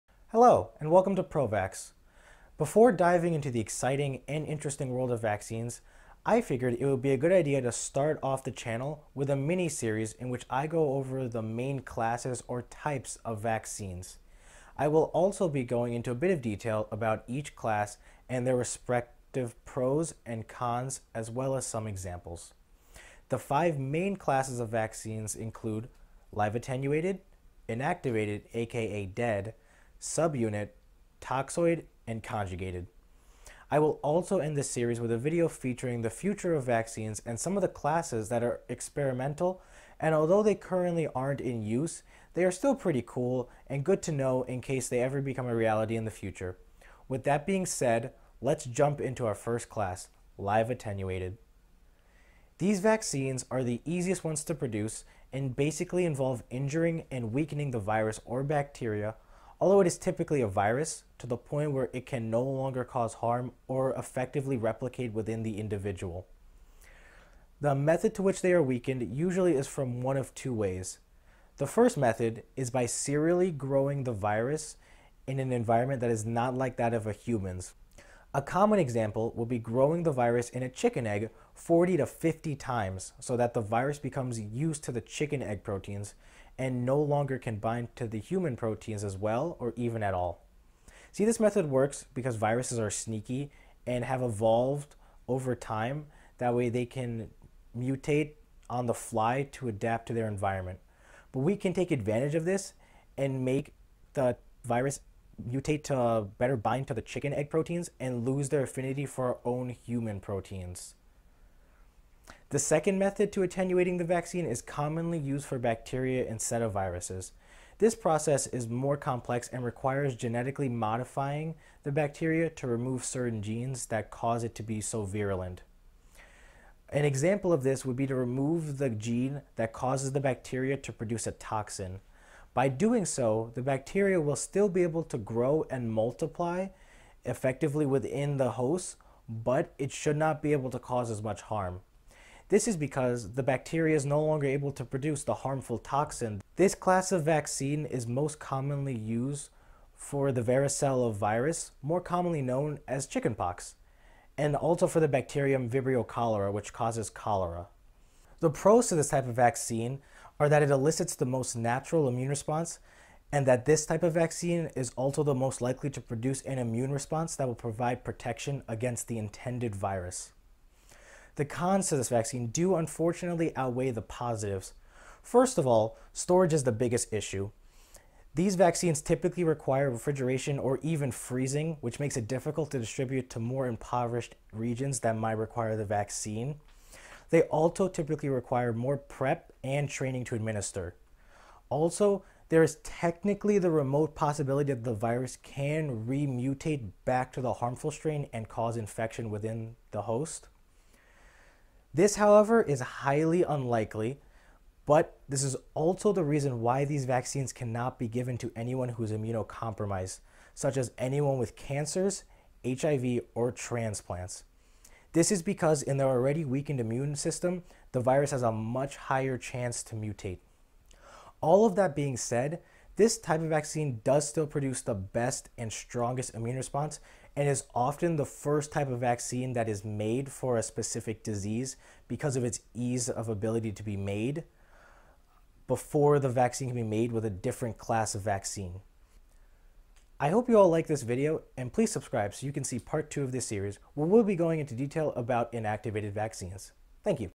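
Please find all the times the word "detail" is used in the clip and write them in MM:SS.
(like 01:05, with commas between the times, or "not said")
00:16, 04:04.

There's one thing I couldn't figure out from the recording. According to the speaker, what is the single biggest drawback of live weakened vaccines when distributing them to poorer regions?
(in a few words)
storage.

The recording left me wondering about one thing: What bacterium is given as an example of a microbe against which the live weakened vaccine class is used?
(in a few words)
Vibrio cholera.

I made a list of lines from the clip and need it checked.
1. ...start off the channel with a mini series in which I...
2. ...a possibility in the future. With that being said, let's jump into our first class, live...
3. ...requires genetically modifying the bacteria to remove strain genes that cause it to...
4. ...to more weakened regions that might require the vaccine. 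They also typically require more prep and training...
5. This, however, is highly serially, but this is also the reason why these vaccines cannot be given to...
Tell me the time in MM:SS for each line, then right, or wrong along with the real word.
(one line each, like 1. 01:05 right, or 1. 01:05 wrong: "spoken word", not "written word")
1. 00:07 right
2. 00:45 wrong: "reality", not "possibility"
3. 01:59 wrong: "certain", not "strain"
4. 03:03 wrong: "impoverished", not "weakened"
5. 03:21 wrong: "unlikely", not "serially".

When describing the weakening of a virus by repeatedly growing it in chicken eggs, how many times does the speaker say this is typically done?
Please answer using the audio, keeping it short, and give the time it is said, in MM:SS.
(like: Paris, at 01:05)
40 to 50, at 01:21.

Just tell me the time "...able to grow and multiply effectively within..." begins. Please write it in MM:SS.
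02:14.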